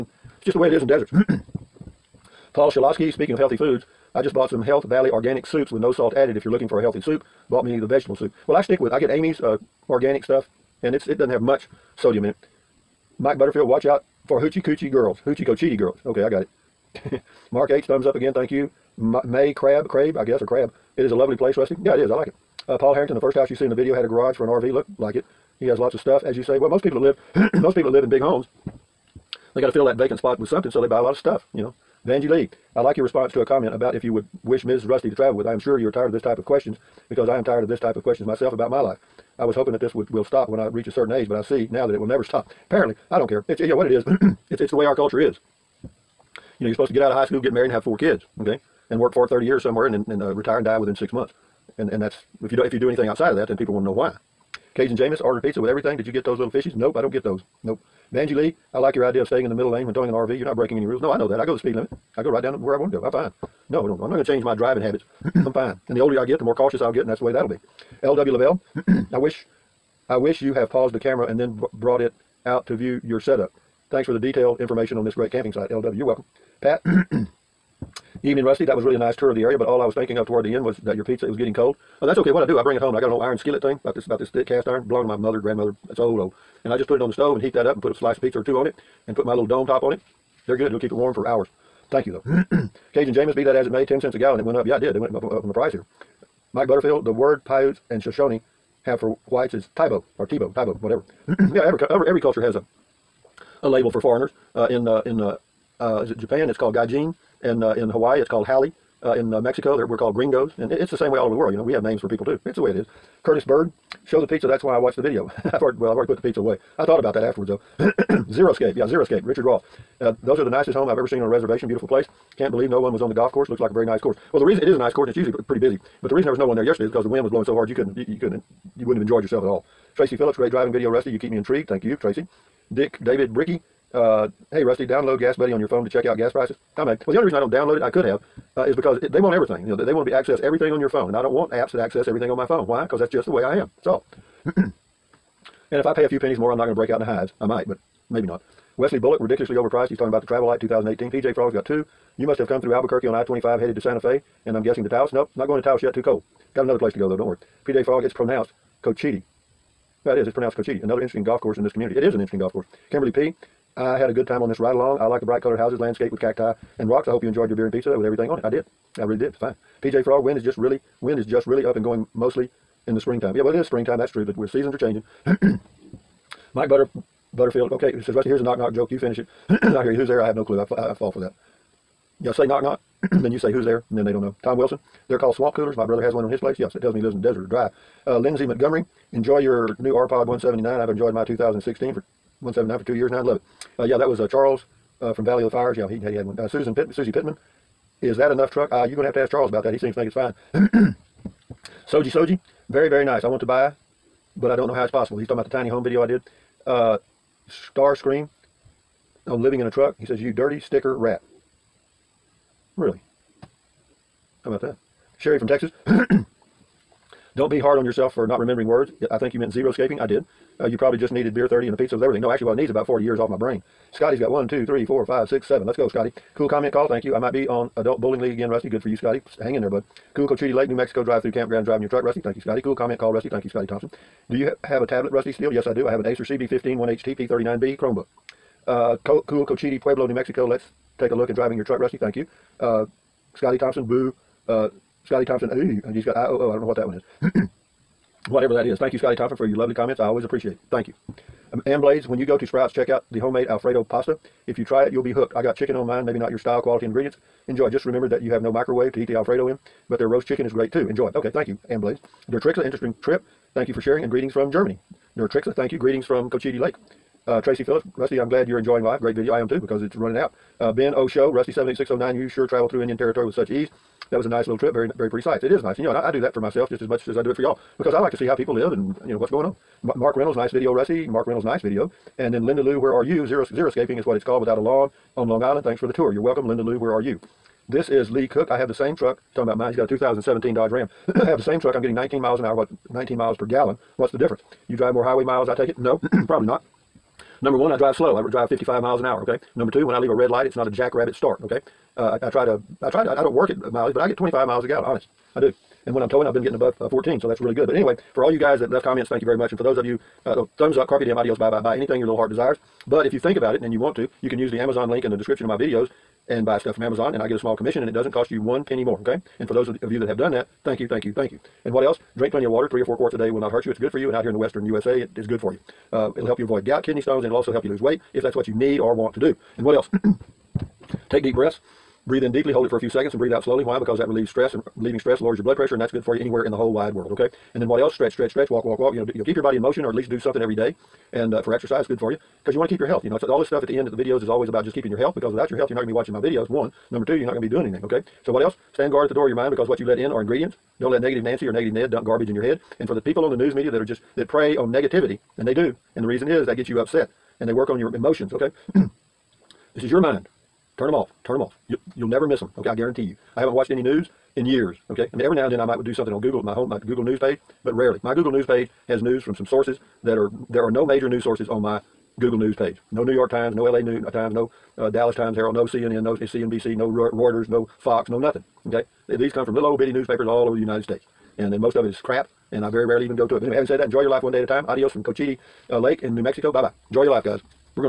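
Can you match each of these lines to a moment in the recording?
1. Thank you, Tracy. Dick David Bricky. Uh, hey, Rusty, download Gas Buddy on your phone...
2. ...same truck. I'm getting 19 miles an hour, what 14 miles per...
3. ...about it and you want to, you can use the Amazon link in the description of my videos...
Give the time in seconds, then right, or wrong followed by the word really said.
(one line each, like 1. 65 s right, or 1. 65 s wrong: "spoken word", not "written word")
1. 131 s right
2. 291 s wrong: "19", not "14"
3. 313 s right.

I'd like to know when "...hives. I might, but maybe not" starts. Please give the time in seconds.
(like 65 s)
147 s.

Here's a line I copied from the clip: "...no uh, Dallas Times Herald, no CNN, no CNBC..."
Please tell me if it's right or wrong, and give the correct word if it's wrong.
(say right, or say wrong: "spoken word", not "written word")
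right.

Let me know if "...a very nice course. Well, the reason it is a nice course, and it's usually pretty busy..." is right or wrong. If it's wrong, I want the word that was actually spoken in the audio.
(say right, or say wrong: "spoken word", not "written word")
right.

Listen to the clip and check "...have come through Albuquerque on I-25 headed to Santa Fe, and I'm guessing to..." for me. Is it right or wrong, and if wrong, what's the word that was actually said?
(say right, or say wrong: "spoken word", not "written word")
right.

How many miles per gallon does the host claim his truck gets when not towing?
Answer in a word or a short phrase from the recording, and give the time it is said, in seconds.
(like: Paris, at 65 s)
25, at 304 s.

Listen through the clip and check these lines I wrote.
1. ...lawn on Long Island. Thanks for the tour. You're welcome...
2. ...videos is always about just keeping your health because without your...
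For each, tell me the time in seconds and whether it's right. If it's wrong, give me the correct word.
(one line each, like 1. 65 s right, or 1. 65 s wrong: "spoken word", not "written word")
1. 284 s right
2. 343 s right.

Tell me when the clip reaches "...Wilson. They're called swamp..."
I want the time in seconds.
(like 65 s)
184 s.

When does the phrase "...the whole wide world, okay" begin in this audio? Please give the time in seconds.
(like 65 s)
336 s.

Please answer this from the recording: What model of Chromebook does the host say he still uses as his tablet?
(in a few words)
Acer CB15.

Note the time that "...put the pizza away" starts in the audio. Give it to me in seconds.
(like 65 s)
116 s.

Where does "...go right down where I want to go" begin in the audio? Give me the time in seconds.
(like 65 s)
62 s.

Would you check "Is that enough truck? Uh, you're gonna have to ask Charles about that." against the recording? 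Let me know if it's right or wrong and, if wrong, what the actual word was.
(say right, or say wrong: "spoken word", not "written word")
right.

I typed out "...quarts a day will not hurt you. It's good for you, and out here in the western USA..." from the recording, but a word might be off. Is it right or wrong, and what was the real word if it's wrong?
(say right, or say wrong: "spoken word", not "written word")
right.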